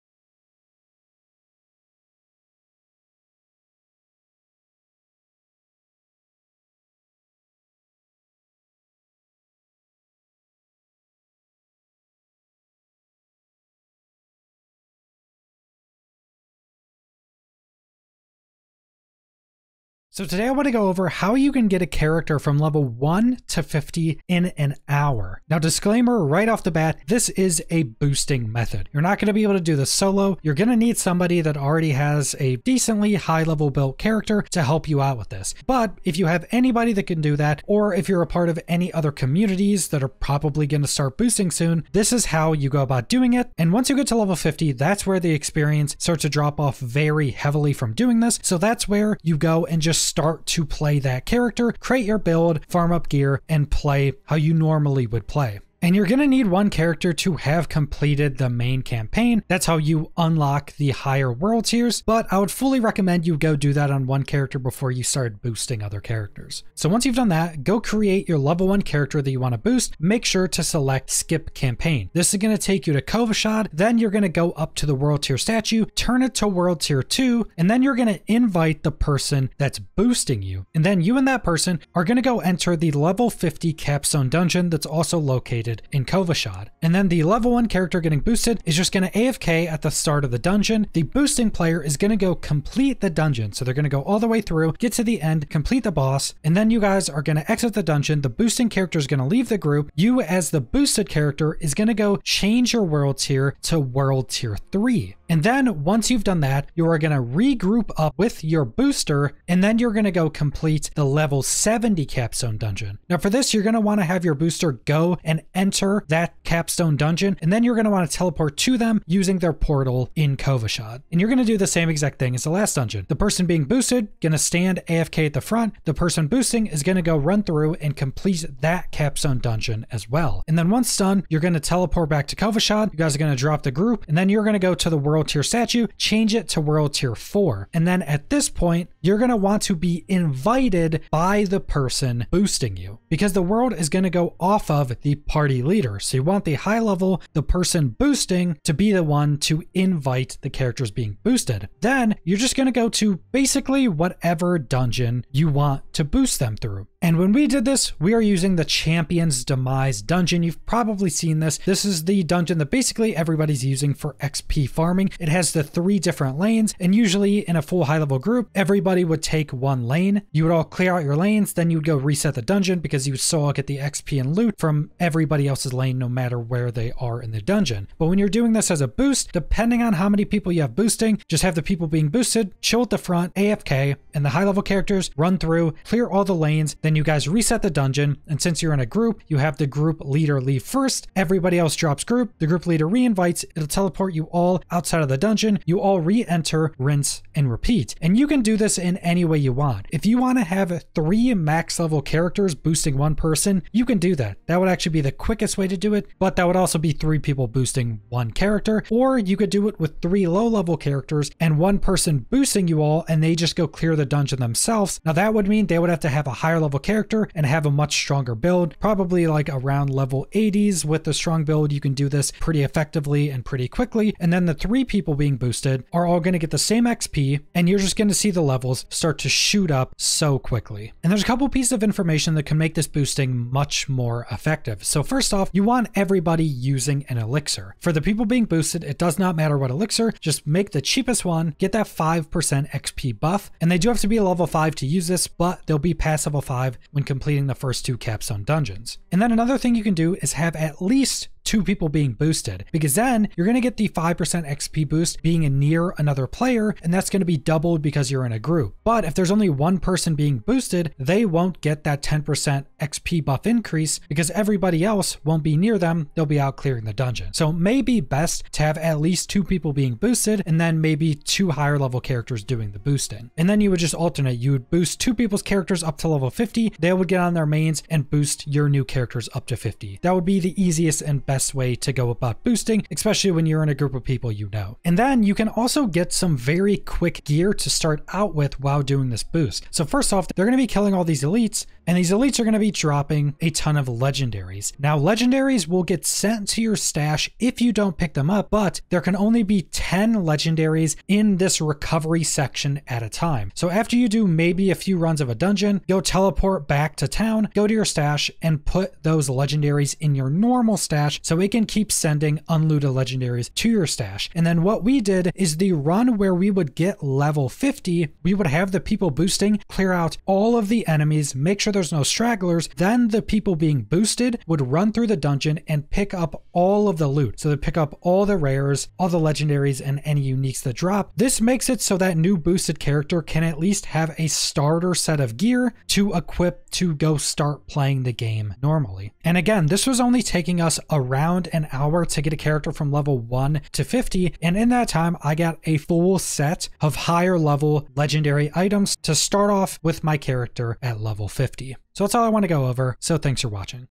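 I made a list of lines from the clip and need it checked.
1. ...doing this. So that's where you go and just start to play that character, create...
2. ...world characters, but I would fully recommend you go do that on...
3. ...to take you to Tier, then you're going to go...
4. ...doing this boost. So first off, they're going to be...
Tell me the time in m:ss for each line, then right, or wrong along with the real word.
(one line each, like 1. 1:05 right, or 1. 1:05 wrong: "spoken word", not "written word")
1. 0:47 right
2. 1:01 wrong: "tiers", not "characters"
3. 1:12 wrong: "Kyovashad", not "Tier"
4. 4:48 right.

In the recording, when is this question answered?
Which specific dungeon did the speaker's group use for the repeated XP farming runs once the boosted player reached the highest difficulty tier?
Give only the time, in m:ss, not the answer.
2:38.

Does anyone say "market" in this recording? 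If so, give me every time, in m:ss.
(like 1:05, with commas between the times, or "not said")
not said.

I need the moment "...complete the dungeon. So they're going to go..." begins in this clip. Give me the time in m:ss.
1:32.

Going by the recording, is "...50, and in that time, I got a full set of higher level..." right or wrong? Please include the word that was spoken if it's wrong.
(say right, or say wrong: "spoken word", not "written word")
right.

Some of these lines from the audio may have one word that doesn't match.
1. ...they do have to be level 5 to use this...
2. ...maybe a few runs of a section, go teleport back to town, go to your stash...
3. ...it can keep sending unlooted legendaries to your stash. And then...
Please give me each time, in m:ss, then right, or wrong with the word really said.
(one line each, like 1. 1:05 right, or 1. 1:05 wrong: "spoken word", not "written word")
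1. 4:03 right
2. 5:04 wrong: "dungeon", not "section"
3. 5:11 right.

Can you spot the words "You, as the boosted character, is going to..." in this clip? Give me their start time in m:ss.
1:39.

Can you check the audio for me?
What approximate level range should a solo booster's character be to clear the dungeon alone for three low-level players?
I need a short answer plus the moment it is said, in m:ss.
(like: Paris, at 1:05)
around level 80s, at 3:39.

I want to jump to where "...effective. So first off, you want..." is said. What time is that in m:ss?
3:54.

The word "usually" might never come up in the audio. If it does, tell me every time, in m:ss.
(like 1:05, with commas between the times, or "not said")
2:46.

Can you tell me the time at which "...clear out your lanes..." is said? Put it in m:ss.
2:50.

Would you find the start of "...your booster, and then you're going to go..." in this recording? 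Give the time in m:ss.
1:48.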